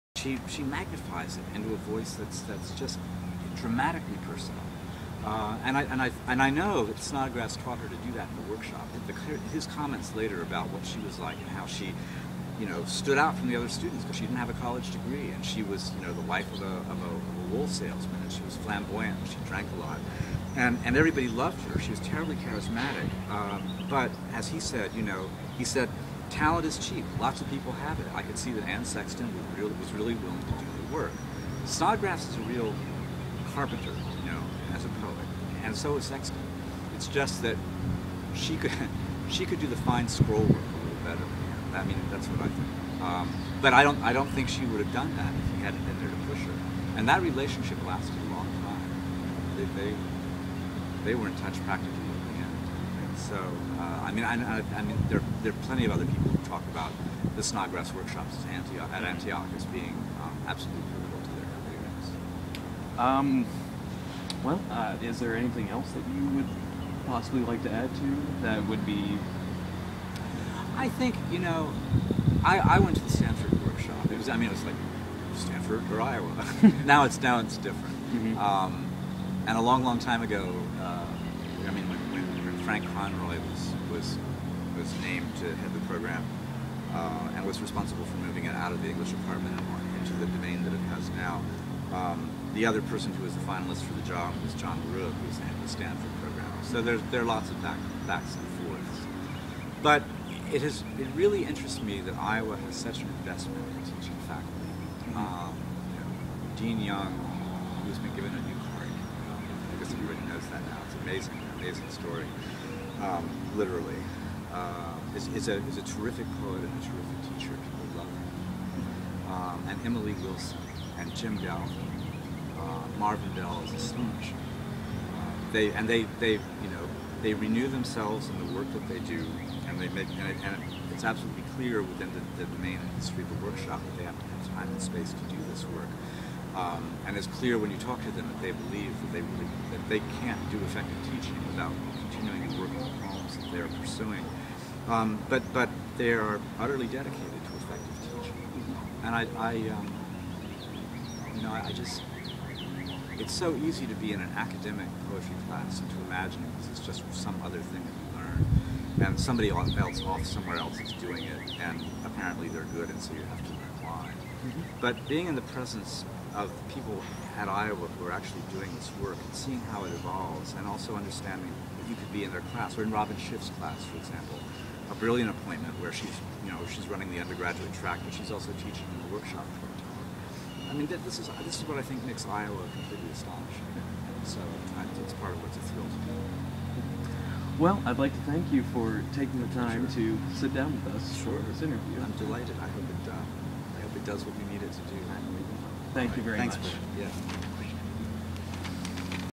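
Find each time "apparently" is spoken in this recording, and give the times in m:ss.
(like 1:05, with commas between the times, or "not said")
2:42.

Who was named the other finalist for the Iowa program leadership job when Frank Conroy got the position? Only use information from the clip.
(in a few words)
John Rook.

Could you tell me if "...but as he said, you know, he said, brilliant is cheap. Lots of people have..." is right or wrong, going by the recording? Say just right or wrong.
wrong.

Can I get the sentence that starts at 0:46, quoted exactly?
And that relationship lasted a long time.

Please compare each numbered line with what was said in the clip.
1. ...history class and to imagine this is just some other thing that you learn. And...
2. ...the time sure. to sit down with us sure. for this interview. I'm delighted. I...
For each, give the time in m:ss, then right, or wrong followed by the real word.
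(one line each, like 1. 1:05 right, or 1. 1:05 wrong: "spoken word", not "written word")
1. 2:35 wrong: "poetry", not "history"
2. 3:09 right.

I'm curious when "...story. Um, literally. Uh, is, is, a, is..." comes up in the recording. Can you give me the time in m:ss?
1:51.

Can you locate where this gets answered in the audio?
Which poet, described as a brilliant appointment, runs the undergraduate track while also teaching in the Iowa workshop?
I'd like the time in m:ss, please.
2:52.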